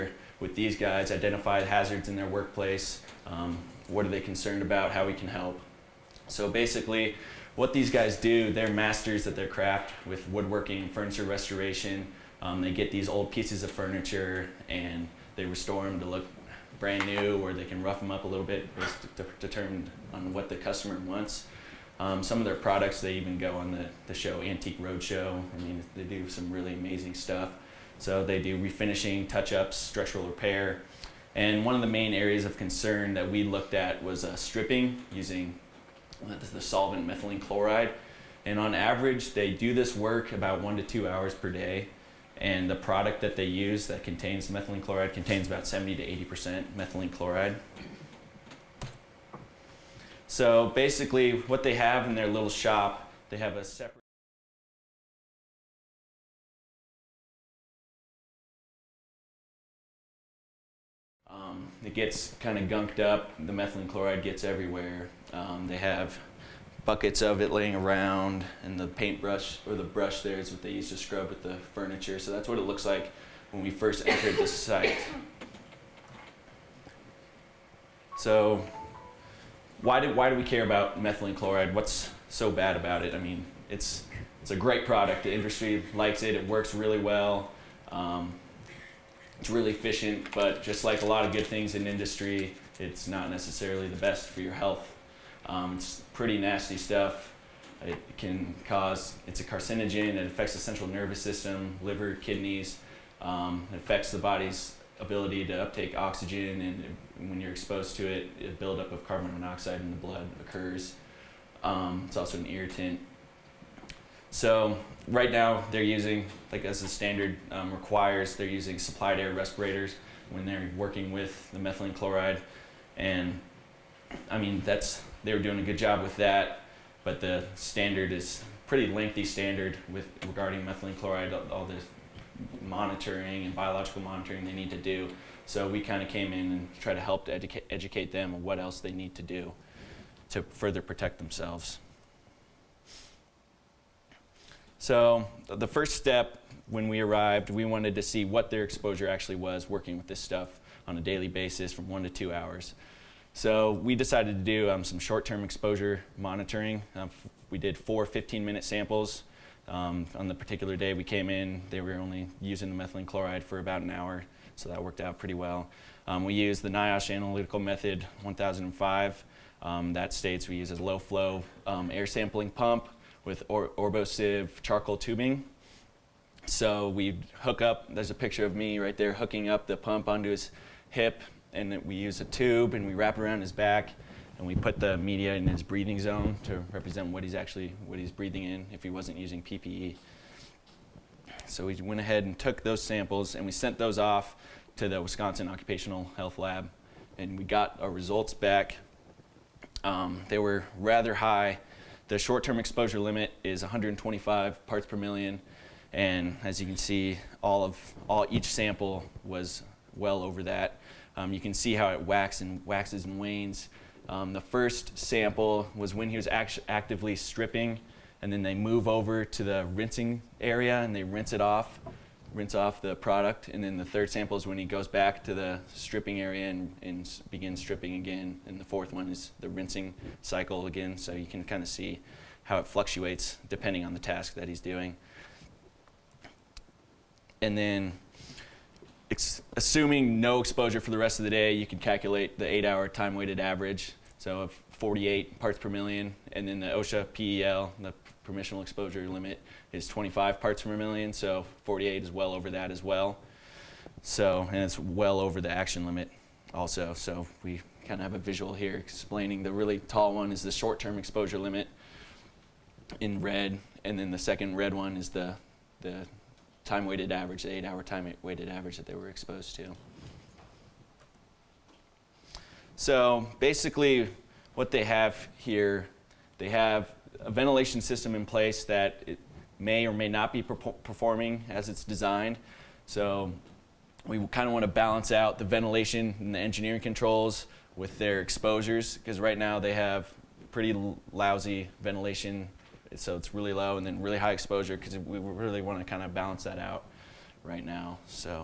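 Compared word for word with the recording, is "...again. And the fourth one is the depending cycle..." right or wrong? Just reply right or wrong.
wrong.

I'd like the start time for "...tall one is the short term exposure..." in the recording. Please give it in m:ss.
4:19.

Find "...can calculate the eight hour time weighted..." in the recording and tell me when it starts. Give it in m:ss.
4:01.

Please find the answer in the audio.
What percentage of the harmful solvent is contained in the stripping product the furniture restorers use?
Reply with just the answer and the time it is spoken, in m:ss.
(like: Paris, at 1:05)
70 to 80%, at 0:45.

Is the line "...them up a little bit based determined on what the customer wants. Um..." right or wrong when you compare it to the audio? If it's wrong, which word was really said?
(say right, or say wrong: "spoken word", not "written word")
right.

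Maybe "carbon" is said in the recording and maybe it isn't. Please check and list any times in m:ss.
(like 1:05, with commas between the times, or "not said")
1:49.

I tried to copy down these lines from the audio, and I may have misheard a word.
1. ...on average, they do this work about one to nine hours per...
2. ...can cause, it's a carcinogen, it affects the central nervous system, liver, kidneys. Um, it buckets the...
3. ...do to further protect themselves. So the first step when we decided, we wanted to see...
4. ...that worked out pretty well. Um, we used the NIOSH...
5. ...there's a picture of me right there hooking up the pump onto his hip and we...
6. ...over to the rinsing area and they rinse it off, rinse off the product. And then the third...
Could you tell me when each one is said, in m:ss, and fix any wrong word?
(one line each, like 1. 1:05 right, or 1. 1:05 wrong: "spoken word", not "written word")
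1. 0:38 wrong: "two", not "nine"
2. 1:38 wrong: "affects", not "buckets"
3. 2:19 wrong: "arrived", not "decided"
4. 2:44 right
5. 2:57 right
6. 3:38 right.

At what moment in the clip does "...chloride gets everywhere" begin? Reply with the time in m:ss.
1:03.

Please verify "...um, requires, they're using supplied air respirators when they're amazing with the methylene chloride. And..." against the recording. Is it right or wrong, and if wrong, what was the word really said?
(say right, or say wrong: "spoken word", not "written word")
wrong: "working", not "amazing".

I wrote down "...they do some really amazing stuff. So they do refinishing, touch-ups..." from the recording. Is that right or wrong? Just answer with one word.
right.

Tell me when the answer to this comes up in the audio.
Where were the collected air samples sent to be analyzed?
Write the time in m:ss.
3:15.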